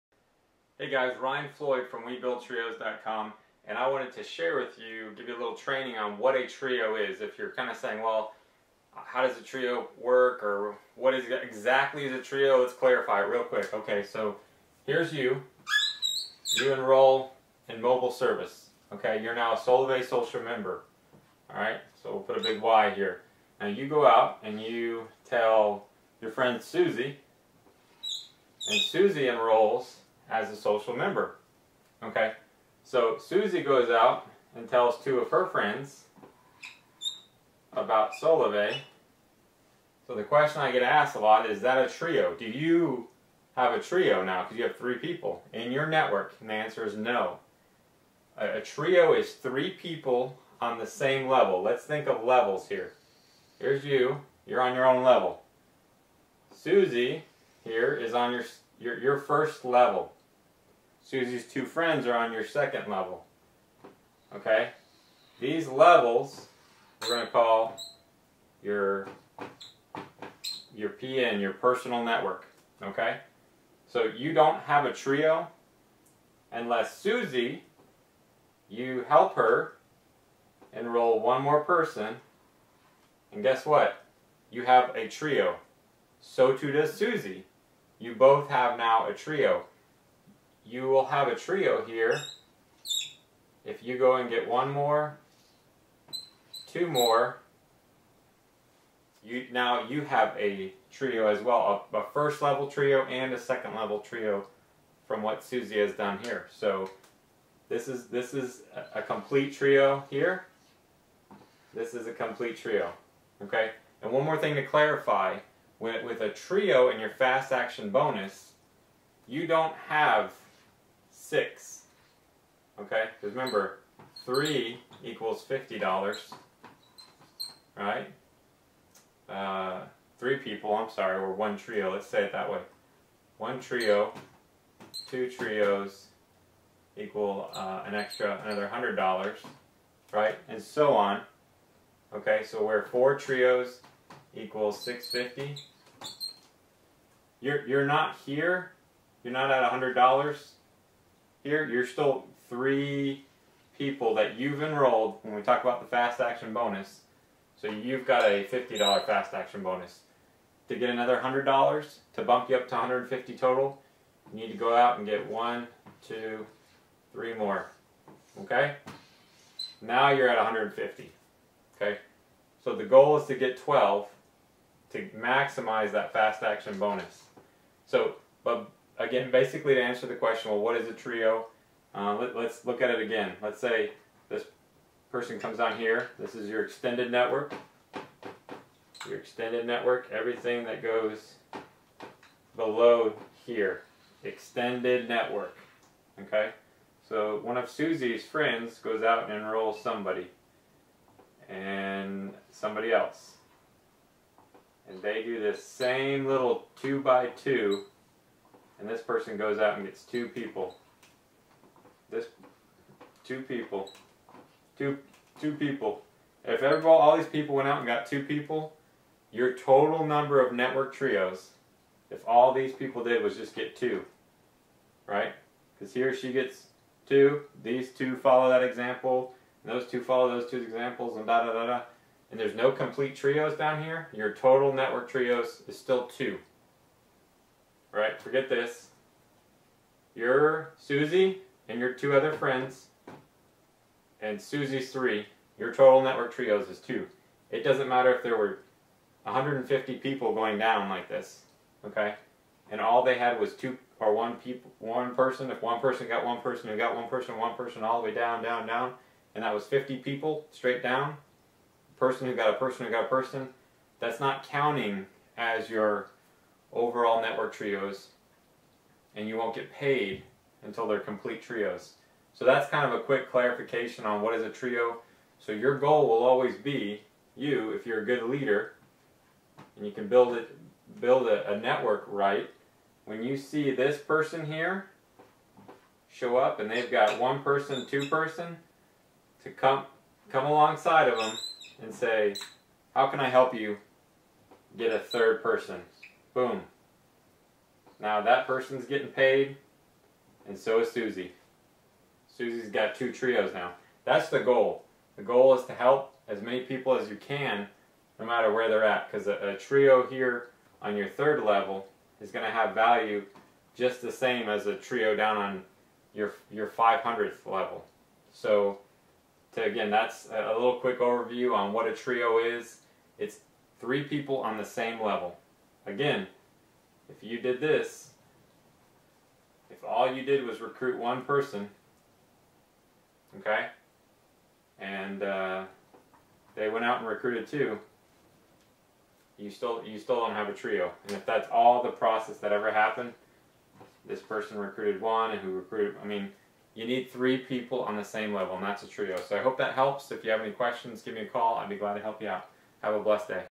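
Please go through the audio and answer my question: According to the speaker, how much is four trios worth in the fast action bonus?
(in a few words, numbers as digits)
650.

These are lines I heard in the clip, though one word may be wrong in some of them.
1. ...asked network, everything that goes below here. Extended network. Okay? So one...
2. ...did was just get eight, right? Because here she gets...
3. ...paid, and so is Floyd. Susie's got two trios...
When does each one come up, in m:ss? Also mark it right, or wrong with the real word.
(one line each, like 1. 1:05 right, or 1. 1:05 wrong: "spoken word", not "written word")
1. 3:09 wrong: "extended", not "asked"
2. 3:43 wrong: "two", not "eight"
3. 4:59 wrong: "Susie", not "Floyd".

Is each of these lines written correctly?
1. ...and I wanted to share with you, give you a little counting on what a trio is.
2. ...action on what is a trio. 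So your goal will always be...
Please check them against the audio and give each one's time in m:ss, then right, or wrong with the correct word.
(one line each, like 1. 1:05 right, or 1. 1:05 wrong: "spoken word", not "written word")
1. 0:03 wrong: "training", not "counting"
2. 4:33 wrong: "clarification", not "action".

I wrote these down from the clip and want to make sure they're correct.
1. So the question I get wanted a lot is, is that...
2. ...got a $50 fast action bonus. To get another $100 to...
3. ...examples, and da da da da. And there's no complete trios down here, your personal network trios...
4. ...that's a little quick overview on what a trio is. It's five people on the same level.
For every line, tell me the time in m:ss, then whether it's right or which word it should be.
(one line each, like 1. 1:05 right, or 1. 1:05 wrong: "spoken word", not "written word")
1. 0:40 wrong: "asked", not "wanted"
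2. 2:38 right
3. 3:50 wrong: "total", not "personal"
4. 5:19 wrong: "three", not "five".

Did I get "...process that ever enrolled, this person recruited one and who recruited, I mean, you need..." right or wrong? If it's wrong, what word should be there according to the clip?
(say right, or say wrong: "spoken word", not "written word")
wrong: "happened", not "enrolled".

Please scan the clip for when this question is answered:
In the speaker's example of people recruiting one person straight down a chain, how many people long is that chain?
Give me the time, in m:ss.
4:19.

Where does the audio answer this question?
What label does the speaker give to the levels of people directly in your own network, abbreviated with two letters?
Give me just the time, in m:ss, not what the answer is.
1:11.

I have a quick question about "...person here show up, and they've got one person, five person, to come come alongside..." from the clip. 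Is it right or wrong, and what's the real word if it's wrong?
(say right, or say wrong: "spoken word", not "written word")
wrong: "two", not "five".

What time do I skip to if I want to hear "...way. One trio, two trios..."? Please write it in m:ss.
2:12.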